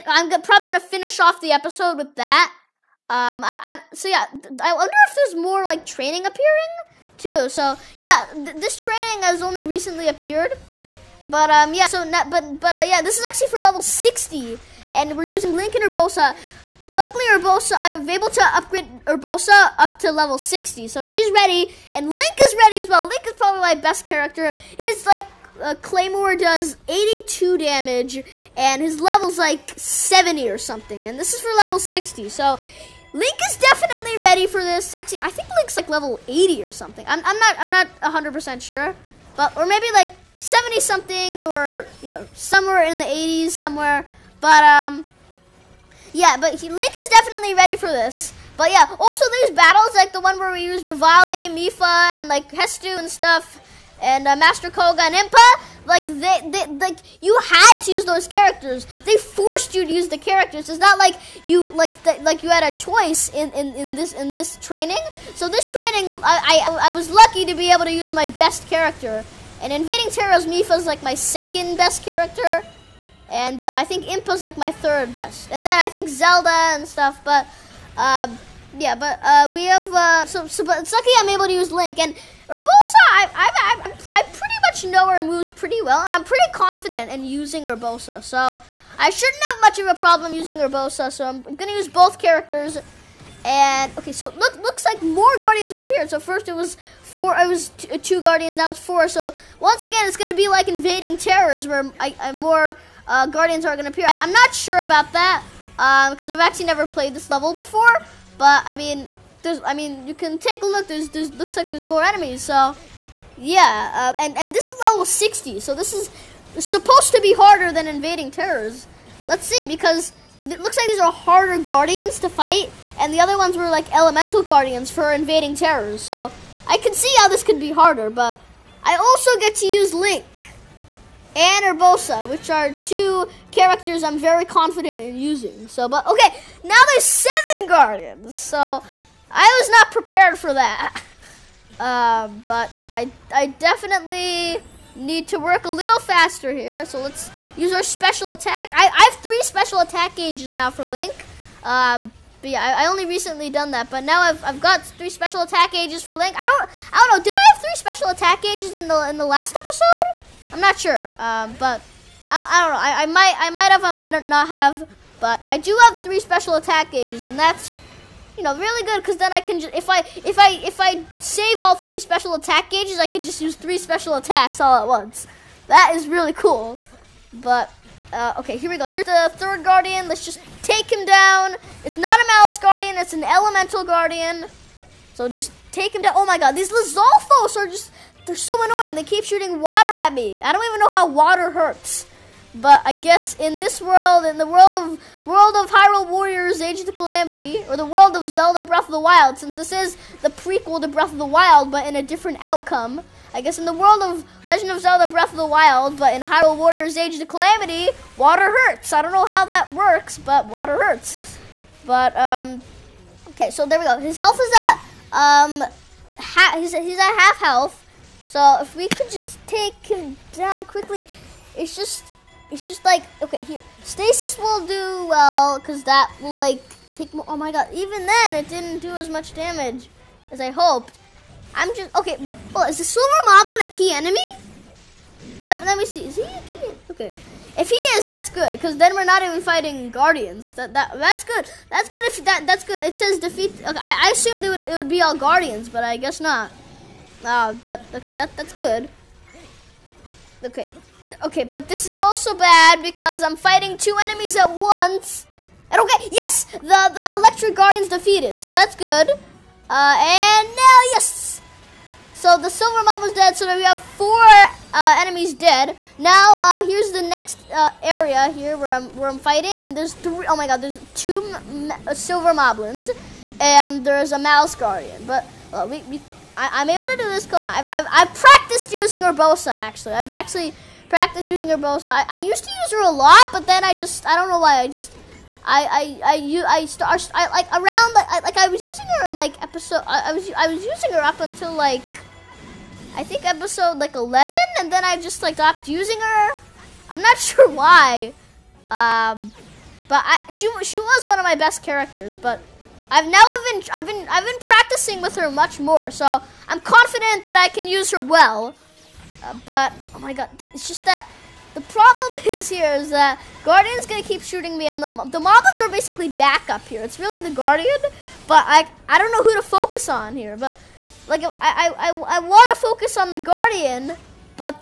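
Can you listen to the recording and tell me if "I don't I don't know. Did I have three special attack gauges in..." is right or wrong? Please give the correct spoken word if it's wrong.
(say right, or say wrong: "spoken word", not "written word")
right.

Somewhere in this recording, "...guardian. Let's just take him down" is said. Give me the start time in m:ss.
2:59.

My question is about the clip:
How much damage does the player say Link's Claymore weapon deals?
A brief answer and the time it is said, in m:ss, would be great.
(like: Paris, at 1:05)
82, at 0:26.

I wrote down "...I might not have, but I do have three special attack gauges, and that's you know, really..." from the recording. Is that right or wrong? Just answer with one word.
right.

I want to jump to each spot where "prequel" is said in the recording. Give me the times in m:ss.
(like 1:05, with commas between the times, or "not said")
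3:20.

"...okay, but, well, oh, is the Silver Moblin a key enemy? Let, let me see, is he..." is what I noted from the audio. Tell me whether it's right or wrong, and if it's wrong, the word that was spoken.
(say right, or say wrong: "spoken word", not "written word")
right.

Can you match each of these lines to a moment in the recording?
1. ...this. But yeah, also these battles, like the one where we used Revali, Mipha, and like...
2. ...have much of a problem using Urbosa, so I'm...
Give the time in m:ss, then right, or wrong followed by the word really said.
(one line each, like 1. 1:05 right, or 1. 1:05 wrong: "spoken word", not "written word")
1. 0:47 right
2. 1:29 right.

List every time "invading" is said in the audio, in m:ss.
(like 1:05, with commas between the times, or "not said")
1:09, 1:40, 1:57, 2:05.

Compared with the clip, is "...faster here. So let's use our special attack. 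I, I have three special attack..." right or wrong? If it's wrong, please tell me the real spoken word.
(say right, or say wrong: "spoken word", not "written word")
right.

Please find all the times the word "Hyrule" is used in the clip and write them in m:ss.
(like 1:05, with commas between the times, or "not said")
3:15, 3:26.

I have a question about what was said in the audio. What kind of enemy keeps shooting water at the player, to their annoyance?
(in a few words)
Lizalfos.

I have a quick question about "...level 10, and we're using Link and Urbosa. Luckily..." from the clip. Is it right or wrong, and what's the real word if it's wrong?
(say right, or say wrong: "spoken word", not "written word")
wrong: "60", not "10".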